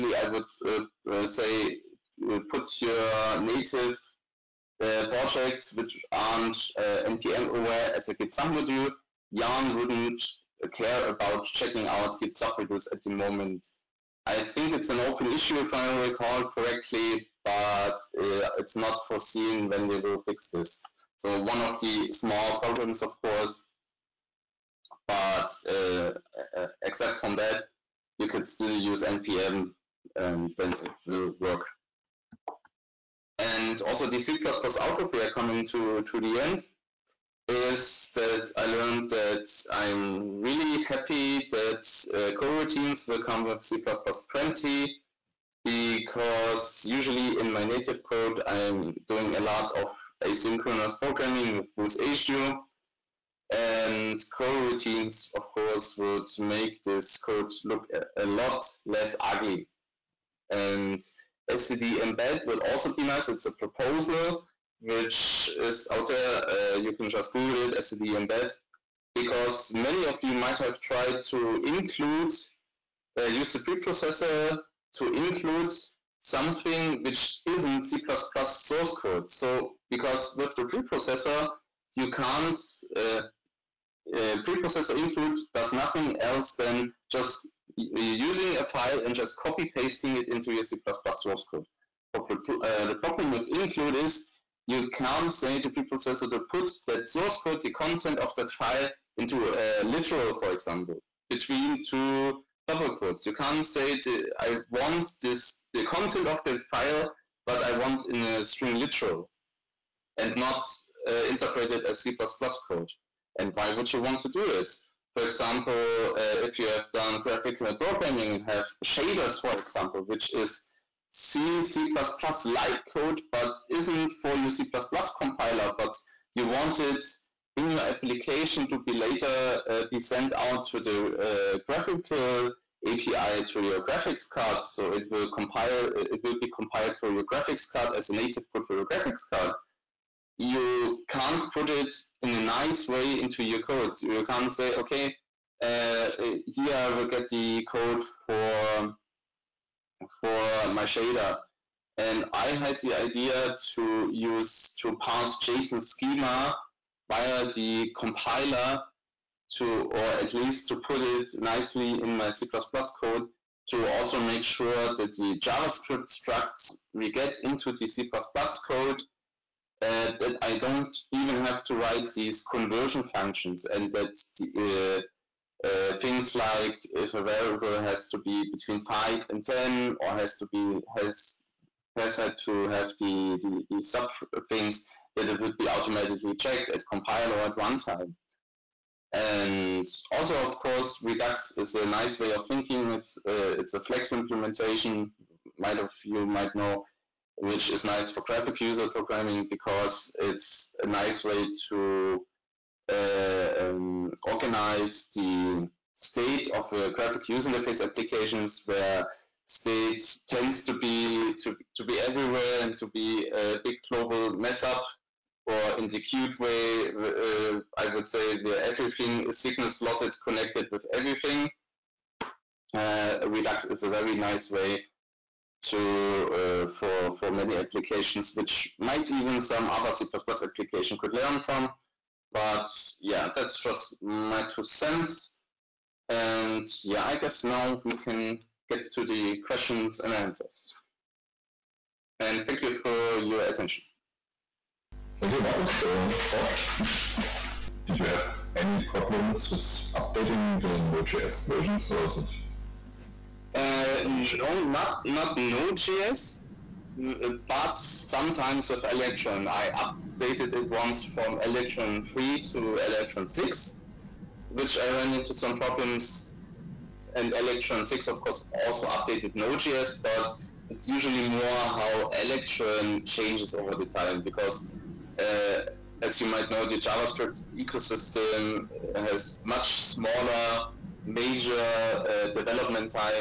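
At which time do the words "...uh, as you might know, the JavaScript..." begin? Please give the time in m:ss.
4:35.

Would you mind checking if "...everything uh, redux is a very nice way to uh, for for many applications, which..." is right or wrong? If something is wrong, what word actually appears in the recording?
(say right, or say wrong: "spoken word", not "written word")
right.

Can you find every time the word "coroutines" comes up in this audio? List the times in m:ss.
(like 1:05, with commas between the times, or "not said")
0:42, 0:54.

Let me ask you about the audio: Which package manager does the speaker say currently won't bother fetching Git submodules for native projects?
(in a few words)
Yarn.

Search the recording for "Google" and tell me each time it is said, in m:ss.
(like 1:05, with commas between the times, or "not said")
1:07.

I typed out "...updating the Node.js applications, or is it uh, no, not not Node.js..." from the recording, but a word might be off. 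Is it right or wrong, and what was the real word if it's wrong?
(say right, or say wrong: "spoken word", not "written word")
wrong: "versions", not "applications".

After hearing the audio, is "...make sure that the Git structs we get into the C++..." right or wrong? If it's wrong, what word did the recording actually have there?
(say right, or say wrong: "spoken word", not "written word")
wrong: "JavaScript", not "Git".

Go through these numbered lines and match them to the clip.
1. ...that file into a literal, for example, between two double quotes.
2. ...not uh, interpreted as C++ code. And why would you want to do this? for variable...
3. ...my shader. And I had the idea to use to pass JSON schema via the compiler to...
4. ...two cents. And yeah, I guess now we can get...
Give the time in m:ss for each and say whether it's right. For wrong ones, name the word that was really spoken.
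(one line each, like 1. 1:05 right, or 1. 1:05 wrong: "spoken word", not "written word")
1. 1:38 right
2. 1:50 wrong: "example", not "variable"
3. 2:30 right
4. 3:54 right.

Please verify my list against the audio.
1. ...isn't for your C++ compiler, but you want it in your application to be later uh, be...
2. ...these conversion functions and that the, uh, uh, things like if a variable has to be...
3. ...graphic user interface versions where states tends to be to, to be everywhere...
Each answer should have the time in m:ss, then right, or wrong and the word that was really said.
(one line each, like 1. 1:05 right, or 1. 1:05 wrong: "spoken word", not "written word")
1. 2:03 right
2. 2:52 right
3. 3:26 wrong: "applications", not "versions".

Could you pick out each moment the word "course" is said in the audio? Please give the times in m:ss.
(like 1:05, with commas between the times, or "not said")
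0:23, 0:55, 3:10, 4:28.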